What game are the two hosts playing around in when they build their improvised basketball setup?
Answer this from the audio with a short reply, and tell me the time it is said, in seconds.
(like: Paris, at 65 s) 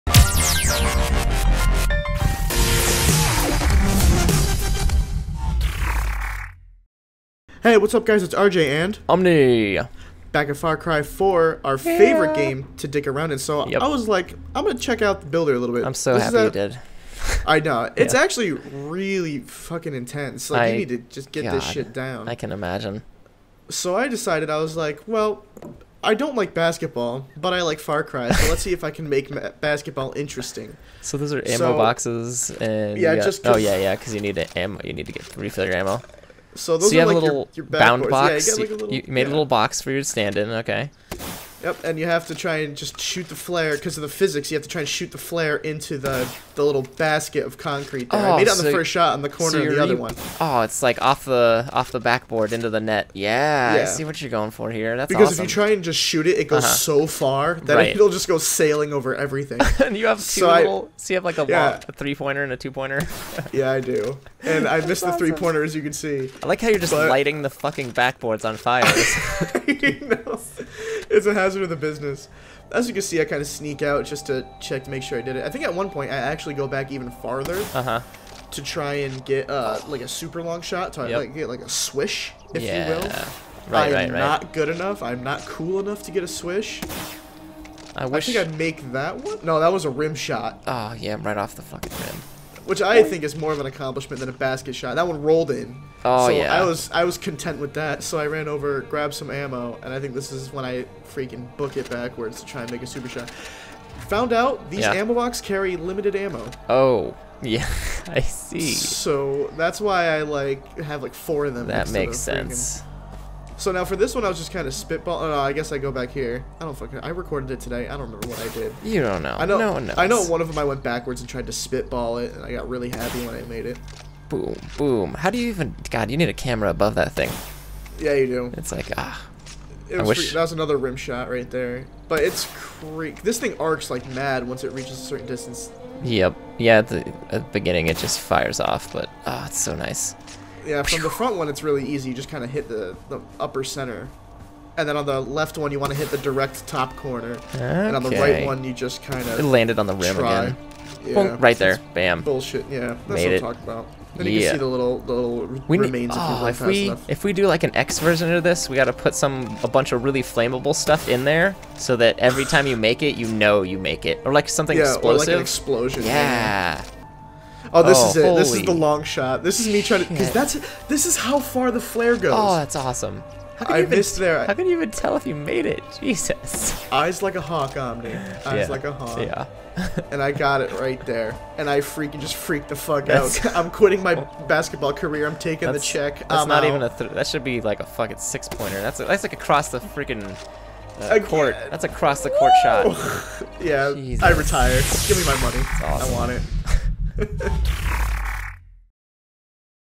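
Far Cry 4, at 10 s.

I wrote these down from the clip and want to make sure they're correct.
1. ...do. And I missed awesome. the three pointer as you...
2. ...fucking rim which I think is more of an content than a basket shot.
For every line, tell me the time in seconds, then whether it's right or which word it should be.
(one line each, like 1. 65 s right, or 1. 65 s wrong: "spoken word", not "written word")
1. 63 s right
2. 91 s wrong: "accomplishment", not "content".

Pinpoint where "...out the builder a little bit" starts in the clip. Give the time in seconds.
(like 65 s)
15 s.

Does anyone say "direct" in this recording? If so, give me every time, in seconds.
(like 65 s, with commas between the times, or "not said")
146 s.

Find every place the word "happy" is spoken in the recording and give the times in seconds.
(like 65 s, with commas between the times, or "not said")
16 s, 122 s.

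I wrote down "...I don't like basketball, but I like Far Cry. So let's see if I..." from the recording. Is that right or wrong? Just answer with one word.
right.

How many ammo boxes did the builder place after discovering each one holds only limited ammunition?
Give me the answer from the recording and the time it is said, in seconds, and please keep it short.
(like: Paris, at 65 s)
4, at 111 s.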